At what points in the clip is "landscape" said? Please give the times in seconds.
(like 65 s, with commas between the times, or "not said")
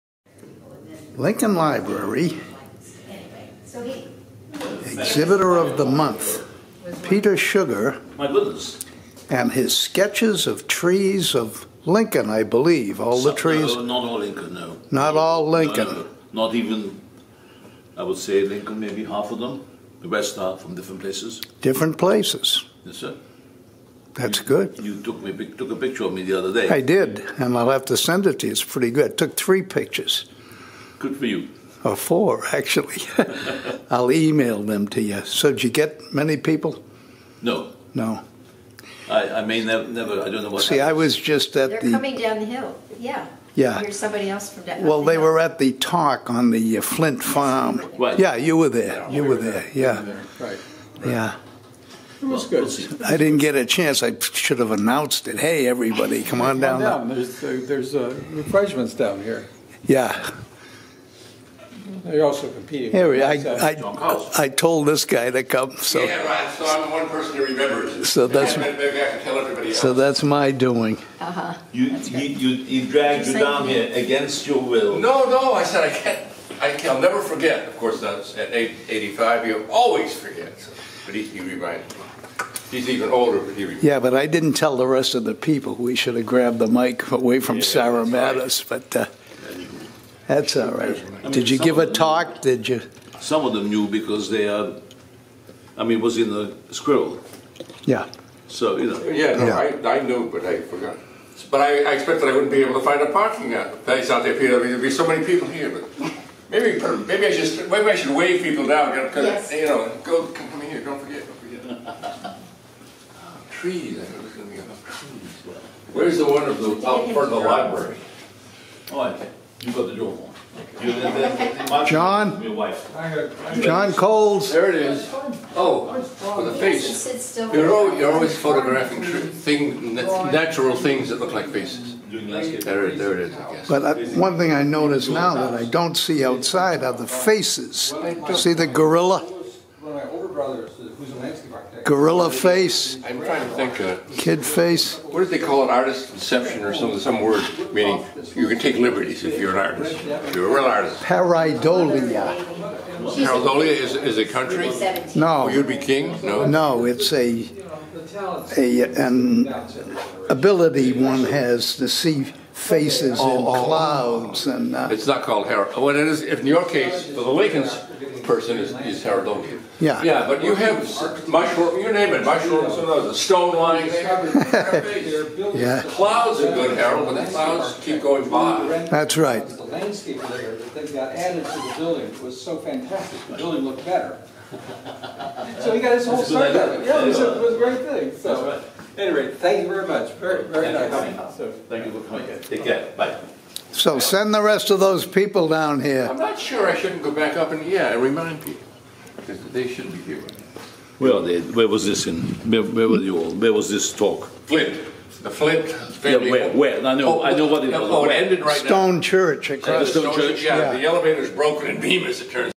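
141 s, 179 s.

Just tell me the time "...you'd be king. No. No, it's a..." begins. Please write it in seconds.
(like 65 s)
155 s.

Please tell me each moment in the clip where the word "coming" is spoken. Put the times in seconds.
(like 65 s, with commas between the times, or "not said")
41 s, 192 s.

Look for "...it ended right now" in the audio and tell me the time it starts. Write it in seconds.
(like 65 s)
208 s.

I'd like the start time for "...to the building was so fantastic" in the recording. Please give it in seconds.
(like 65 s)
181 s.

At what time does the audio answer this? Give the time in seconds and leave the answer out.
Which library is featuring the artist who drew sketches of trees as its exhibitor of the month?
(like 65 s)
1 s.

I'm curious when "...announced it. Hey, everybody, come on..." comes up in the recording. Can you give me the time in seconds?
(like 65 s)
54 s.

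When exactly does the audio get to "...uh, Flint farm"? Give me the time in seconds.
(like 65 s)
46 s.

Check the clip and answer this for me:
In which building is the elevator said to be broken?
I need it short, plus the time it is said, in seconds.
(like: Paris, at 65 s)
Bemis, at 211 s.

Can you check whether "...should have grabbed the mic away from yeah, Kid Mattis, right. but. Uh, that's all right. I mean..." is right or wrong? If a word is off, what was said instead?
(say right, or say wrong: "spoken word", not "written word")
wrong: "Sarah", not "Kid".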